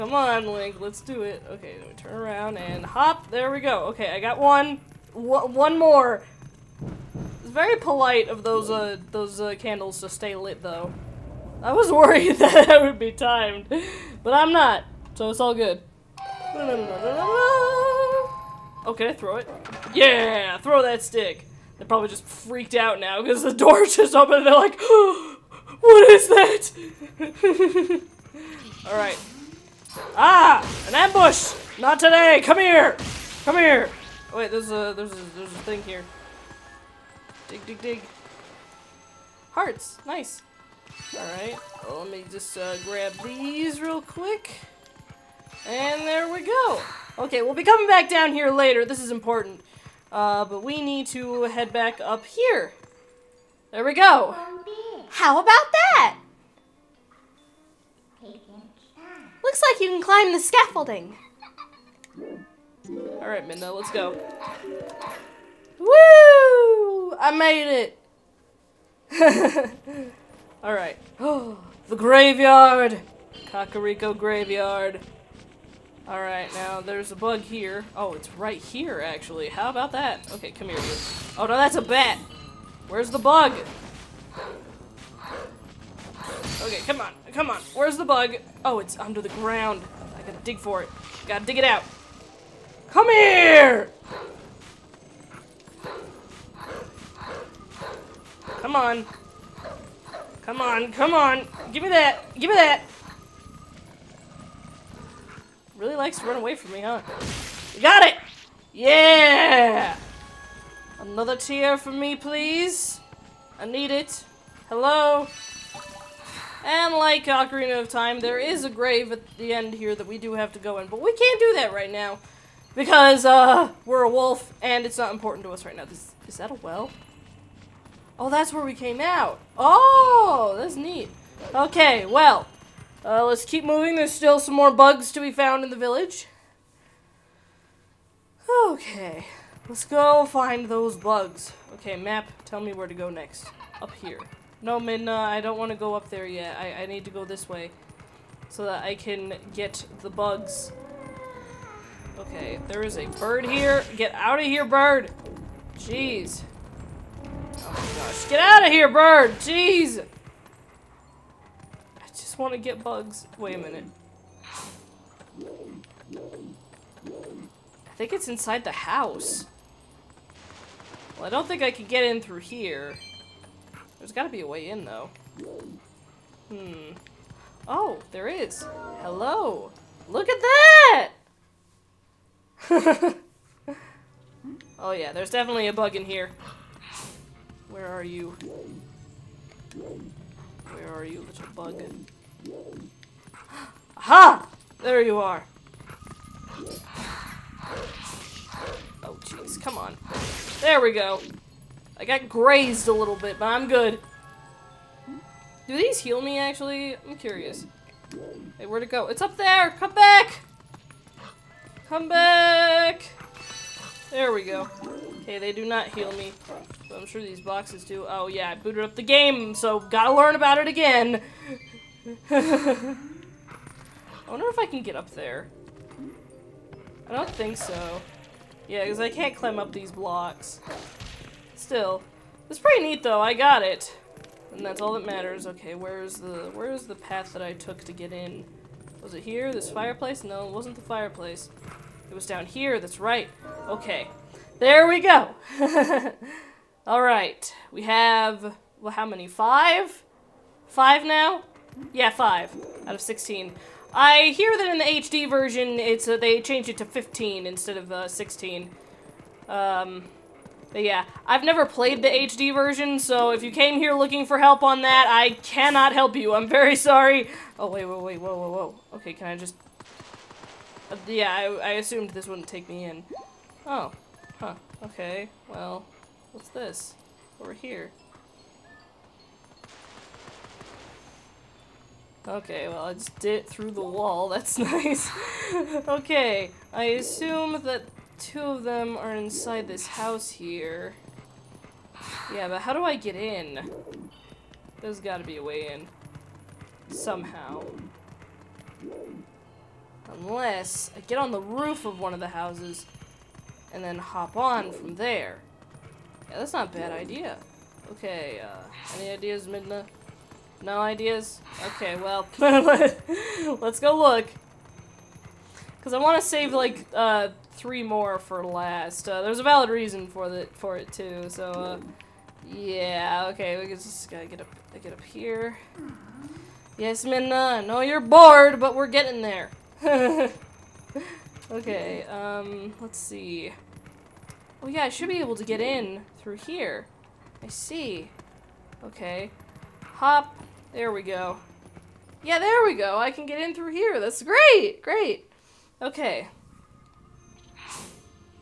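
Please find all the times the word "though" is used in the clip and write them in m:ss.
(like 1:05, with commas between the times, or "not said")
0:10, 2:54, 3:53.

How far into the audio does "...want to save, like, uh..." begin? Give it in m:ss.
5:15.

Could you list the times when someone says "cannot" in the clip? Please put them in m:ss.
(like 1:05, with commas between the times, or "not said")
4:25.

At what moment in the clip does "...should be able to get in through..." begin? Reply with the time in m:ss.
5:34.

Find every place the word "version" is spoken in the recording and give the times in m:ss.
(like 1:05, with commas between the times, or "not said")
4:15, 4:22.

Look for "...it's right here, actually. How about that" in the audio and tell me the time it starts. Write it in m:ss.
1:18.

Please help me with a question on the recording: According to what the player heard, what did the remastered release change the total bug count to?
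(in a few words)
15.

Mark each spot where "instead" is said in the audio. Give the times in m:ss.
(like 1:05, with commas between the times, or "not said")
4:17.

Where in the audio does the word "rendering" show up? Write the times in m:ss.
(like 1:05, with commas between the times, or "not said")
not said.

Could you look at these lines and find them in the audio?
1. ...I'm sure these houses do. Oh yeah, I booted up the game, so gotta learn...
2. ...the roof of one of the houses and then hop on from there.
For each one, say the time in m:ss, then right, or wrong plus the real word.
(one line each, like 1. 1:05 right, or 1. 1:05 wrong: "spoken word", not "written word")
1. 3:36 wrong: "boxes", not "houses"
2. 5:01 right.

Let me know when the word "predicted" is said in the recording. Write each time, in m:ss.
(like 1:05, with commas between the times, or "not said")
not said.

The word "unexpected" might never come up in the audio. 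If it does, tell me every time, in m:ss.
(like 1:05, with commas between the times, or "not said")
not said.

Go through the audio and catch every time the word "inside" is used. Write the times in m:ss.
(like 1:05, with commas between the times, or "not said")
2:48, 4:49.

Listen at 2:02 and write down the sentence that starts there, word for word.
Because, uh, we're a wolf, and it's not important to us right now.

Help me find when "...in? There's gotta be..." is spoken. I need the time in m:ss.
4:53.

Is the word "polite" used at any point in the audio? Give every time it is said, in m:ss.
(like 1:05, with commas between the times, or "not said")
0:07.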